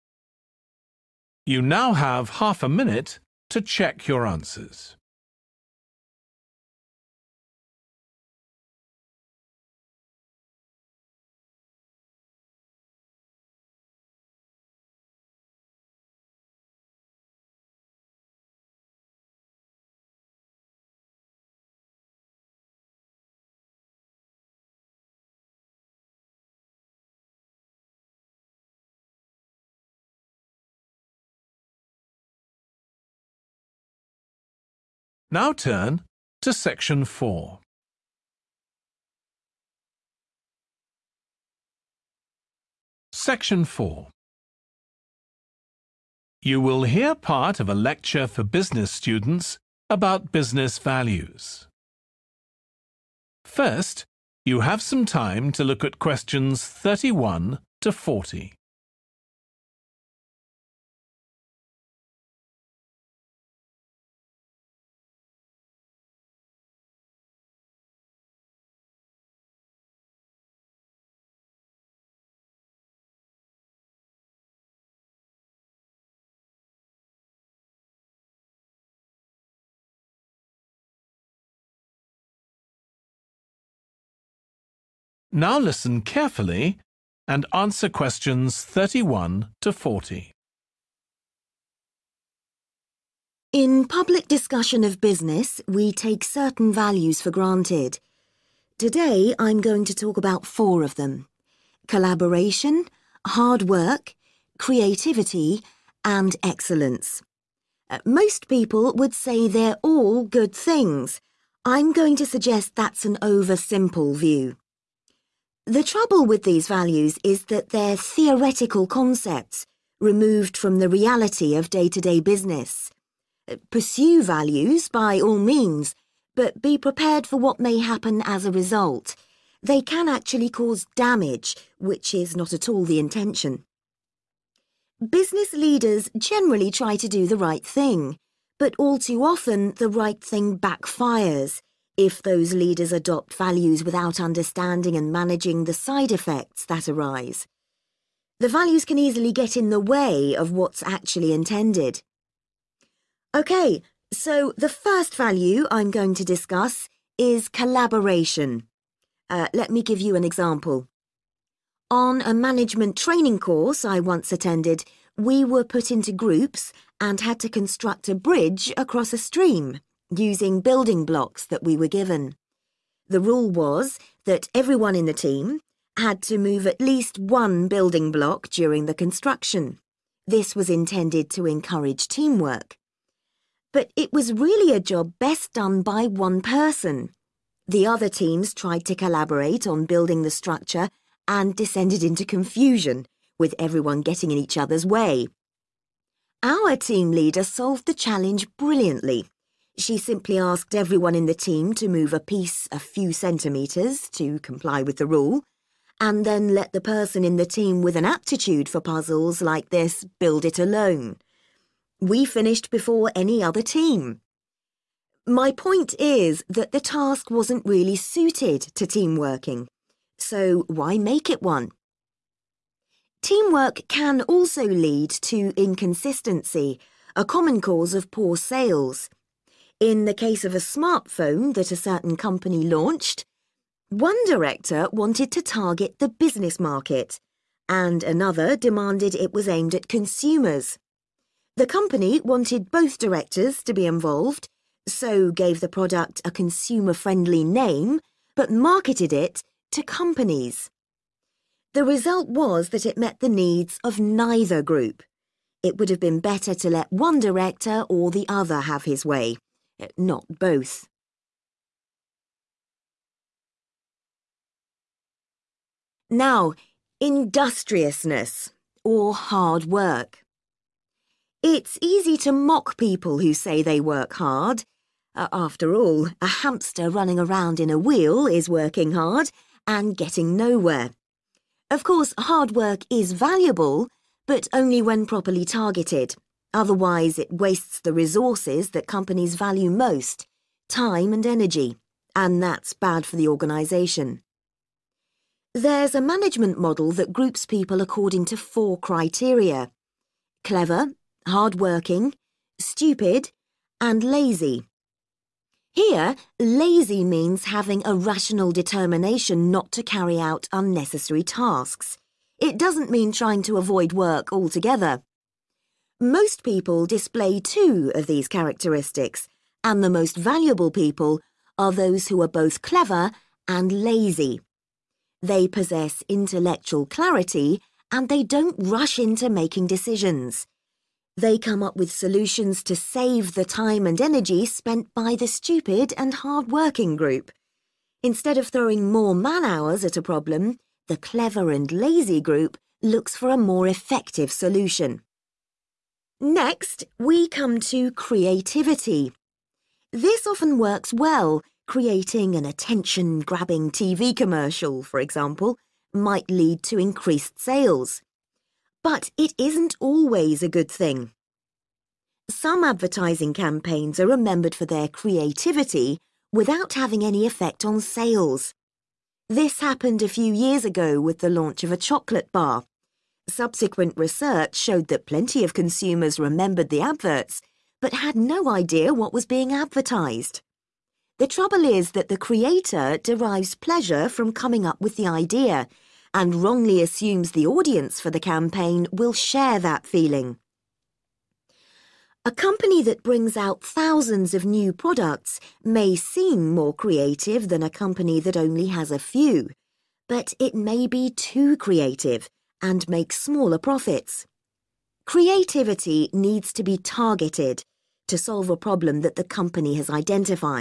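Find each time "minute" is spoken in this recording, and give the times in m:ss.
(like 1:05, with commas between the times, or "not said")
0:02.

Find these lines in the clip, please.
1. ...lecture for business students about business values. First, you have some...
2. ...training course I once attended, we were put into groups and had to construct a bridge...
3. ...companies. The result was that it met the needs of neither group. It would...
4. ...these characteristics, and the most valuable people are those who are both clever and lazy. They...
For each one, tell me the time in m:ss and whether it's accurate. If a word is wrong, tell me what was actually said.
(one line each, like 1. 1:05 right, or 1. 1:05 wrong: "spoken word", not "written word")
1. 0:47 right
2. 2:42 right
3. 4:09 right
4. 5:18 right.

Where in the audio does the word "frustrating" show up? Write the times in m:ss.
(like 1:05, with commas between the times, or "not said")
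not said.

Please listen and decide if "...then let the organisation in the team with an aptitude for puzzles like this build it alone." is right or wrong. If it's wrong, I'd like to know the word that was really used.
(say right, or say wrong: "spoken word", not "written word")
wrong: "person", not "organisation".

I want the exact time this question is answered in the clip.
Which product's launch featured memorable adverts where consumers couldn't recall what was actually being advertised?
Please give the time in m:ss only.
6:11.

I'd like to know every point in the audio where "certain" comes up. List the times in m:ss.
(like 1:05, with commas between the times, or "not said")
1:36, 3:51.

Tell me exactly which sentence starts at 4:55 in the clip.
There's a management model that groups people according to four criteria.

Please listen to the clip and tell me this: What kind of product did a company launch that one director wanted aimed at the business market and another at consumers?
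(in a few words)
smartphone.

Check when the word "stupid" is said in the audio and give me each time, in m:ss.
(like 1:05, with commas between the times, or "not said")
5:02, 5:35.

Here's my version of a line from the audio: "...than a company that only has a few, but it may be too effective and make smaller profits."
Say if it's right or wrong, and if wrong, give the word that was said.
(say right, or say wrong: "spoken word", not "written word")
wrong: "creative", not "effective".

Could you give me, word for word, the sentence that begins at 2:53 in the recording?
The rule was that everyone in the team had to move at least one building block during the construction.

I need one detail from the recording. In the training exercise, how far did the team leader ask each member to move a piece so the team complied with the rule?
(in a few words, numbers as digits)
a few centimetres.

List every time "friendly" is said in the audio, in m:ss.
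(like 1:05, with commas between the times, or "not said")
4:06.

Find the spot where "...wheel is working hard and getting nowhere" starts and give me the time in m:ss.
4:37.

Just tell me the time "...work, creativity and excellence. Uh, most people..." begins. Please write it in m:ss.
1:43.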